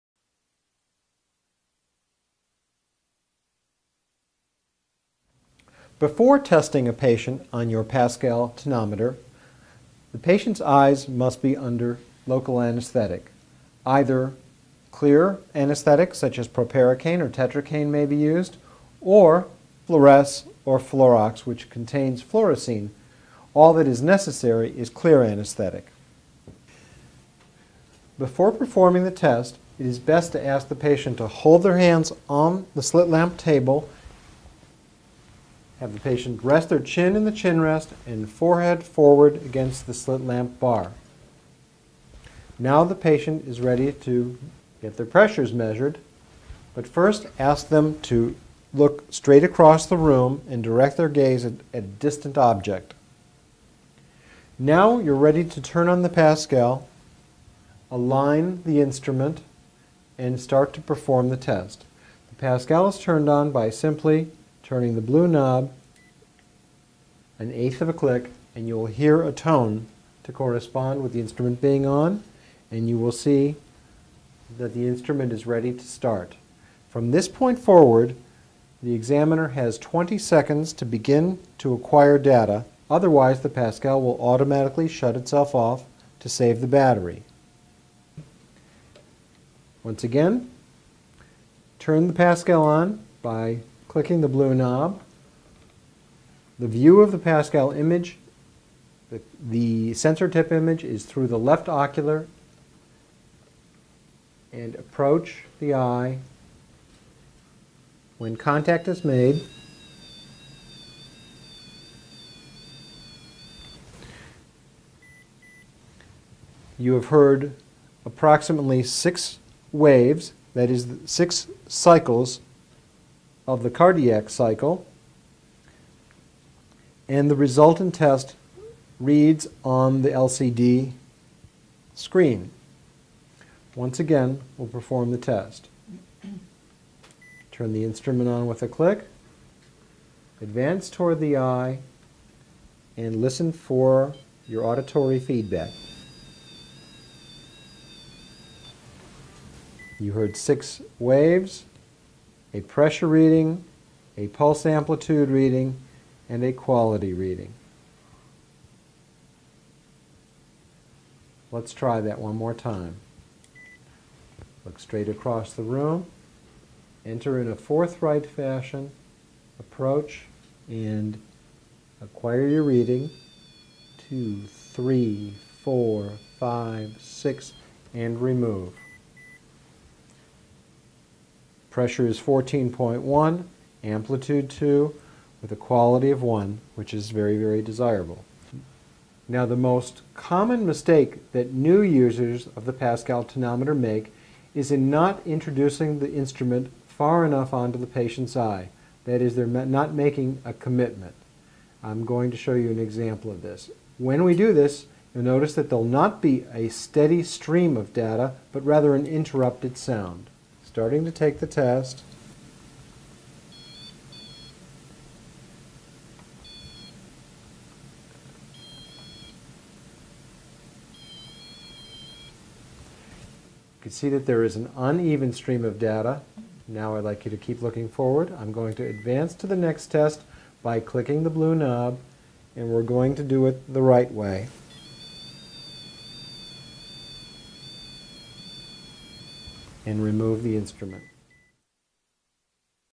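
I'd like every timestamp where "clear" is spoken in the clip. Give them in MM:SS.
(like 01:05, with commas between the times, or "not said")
00:14, 00:24.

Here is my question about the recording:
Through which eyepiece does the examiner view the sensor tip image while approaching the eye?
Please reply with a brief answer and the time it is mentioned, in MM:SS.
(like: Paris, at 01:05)
left ocular, at 01:41.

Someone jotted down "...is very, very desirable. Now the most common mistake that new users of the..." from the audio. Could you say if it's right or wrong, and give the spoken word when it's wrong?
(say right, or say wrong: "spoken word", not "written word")
right.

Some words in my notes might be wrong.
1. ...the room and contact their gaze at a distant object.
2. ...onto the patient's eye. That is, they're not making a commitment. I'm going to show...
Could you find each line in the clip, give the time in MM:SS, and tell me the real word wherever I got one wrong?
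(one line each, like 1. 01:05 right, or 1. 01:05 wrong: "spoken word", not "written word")
1. 00:49 wrong: "direct", not "contact"
2. 03:17 right.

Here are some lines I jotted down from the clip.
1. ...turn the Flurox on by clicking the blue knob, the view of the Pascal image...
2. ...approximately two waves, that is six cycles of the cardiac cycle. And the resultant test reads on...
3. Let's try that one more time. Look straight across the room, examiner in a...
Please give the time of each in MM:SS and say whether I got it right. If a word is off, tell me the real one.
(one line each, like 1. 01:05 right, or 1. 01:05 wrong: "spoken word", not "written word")
1. 01:31 wrong: "Pascal", not "Flurox"
2. 01:58 wrong: "six", not "two"
3. 02:41 wrong: "enter", not "examiner".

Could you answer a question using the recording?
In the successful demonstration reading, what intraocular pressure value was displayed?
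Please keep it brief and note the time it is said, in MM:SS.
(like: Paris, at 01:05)
14.1, at 03:02.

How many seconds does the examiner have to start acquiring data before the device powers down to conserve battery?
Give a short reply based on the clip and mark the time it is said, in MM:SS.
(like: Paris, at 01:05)
20, at 01:19.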